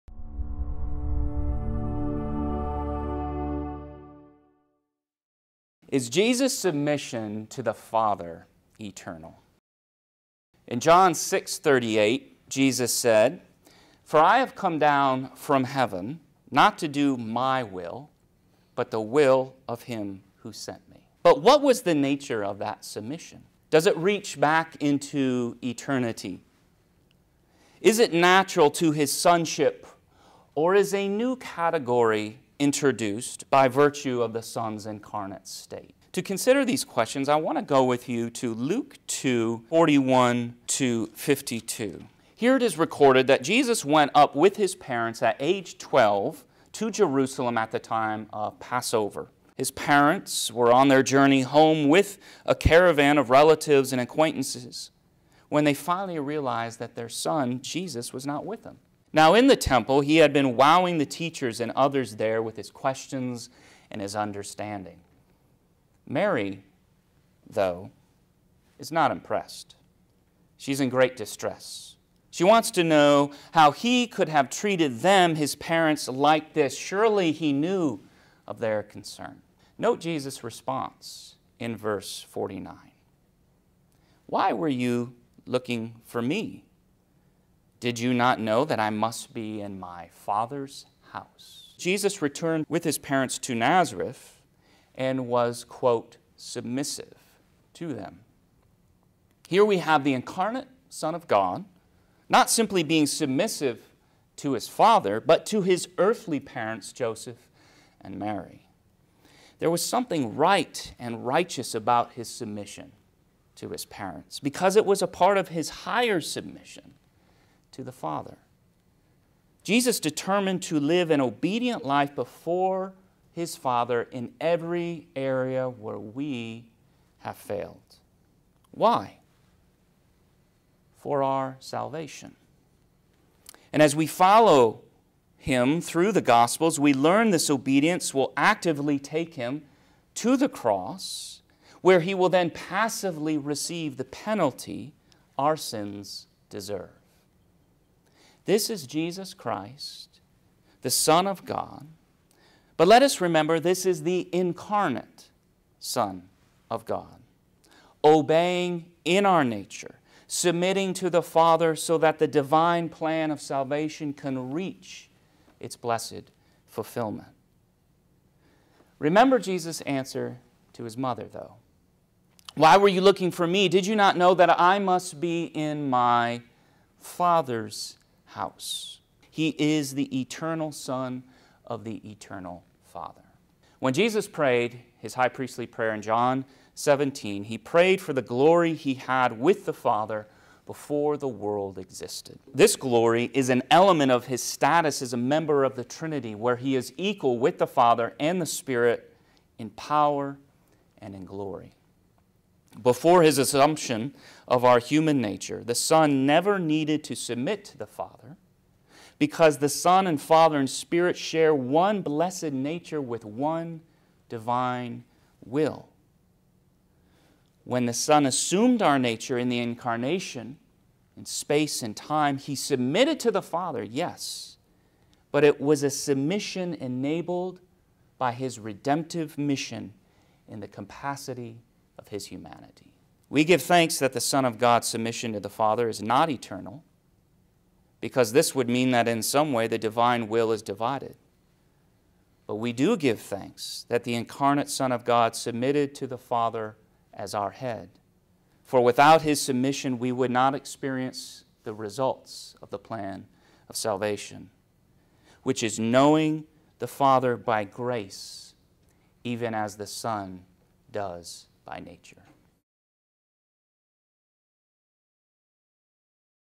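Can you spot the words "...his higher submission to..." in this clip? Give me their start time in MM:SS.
01:55.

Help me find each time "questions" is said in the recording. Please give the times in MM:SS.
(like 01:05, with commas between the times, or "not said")
00:36, 01:02.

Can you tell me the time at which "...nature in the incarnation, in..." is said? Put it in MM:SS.
03:38.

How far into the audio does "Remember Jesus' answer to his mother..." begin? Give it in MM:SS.
02:48.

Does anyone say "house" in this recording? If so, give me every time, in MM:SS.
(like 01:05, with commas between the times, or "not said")
01:31, 02:58.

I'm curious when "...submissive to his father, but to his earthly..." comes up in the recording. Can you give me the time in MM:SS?
01:43.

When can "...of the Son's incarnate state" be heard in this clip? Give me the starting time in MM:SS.
00:34.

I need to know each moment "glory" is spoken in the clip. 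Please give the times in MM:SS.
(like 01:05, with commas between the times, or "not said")
03:08, 03:12, 03:21.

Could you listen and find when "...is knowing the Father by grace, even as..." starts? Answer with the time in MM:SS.
04:15.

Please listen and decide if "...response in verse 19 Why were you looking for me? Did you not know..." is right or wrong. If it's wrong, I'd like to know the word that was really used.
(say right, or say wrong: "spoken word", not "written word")
wrong: "49", not "19".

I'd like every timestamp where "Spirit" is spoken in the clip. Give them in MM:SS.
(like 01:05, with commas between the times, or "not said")
03:18, 03:30.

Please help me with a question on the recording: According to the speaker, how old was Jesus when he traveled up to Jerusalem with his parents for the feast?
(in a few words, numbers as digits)
12.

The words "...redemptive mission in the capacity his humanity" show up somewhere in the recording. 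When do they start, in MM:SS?
03:48.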